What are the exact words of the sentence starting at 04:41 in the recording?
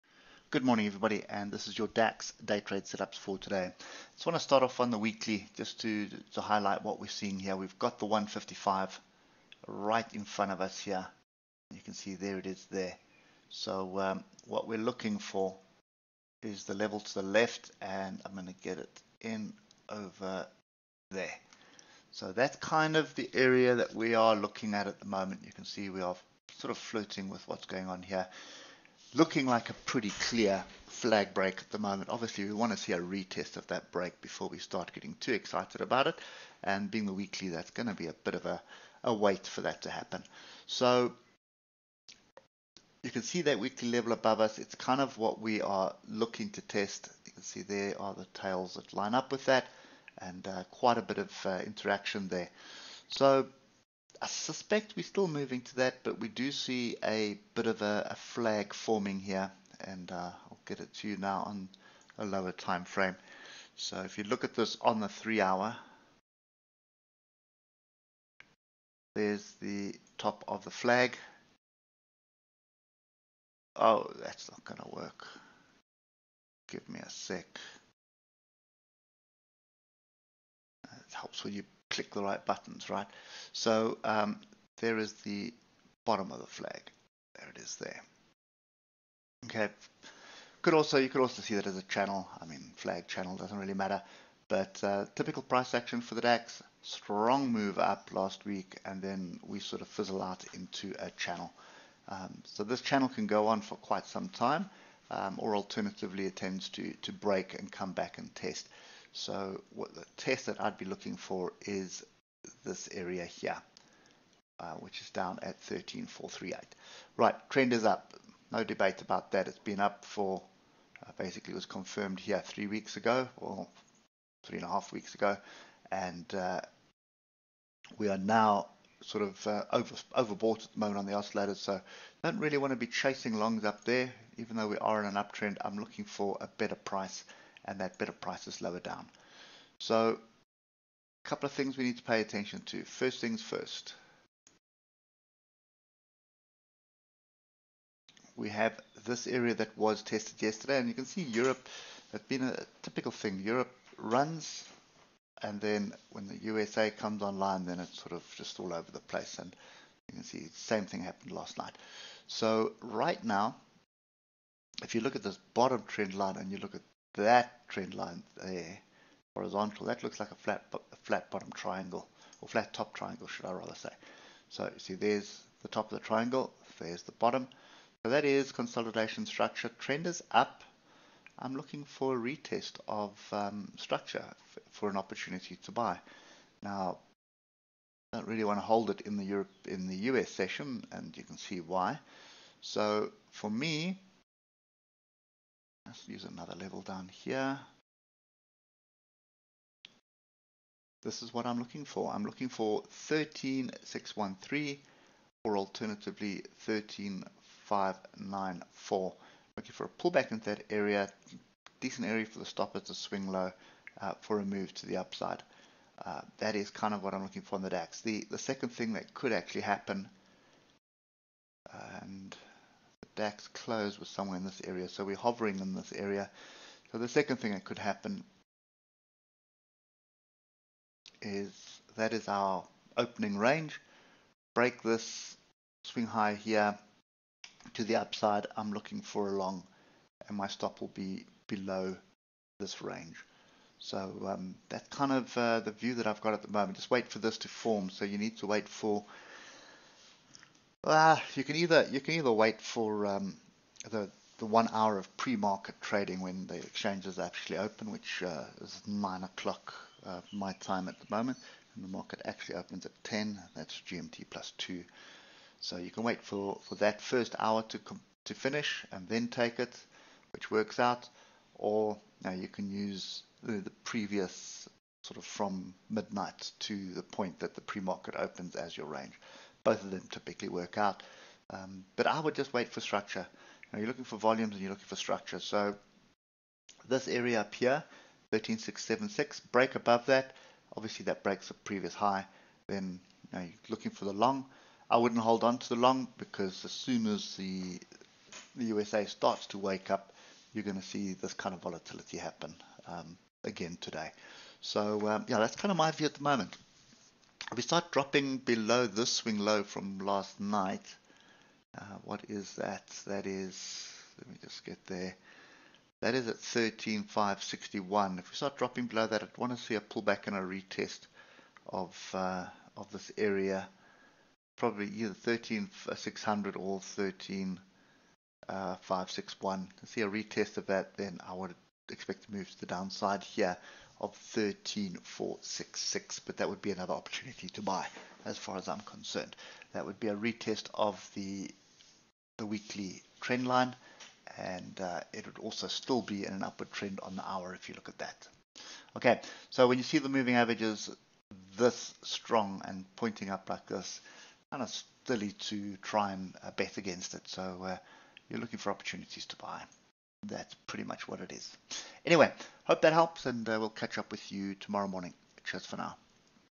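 Um, but I would just wait for structure.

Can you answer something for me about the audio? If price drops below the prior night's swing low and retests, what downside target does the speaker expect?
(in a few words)
13466.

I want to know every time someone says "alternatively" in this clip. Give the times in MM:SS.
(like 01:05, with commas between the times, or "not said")
01:45, 03:25.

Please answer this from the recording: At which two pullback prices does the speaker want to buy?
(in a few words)
13613 or 13594.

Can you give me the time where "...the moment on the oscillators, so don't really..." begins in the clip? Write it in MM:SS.
02:10.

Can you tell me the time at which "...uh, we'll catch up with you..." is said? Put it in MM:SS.
06:03.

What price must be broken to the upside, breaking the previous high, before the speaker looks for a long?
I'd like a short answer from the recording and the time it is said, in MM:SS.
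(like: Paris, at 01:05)
13676, at 04:48.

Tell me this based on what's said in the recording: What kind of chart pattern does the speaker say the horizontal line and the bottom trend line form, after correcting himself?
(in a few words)
flat top triangle.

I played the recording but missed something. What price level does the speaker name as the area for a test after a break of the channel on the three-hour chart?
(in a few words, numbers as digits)
13,438.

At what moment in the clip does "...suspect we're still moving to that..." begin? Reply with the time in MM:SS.
00:54.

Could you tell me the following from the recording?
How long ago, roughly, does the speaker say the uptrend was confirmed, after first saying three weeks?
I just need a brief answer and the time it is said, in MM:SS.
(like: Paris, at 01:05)
three and a half weeks, at 02:04.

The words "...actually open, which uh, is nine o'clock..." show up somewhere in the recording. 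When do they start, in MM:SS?
04:17.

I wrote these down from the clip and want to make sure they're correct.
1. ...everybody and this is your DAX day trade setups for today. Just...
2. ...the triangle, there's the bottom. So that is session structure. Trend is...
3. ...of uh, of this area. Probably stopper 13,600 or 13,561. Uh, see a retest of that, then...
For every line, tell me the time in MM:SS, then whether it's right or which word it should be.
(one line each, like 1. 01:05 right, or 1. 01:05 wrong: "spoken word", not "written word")
1. 00:00 right
2. 02:55 wrong: "consolidation", not "session"
3. 05:21 wrong: "either", not "stopper".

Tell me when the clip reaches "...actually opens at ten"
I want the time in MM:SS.
04:22.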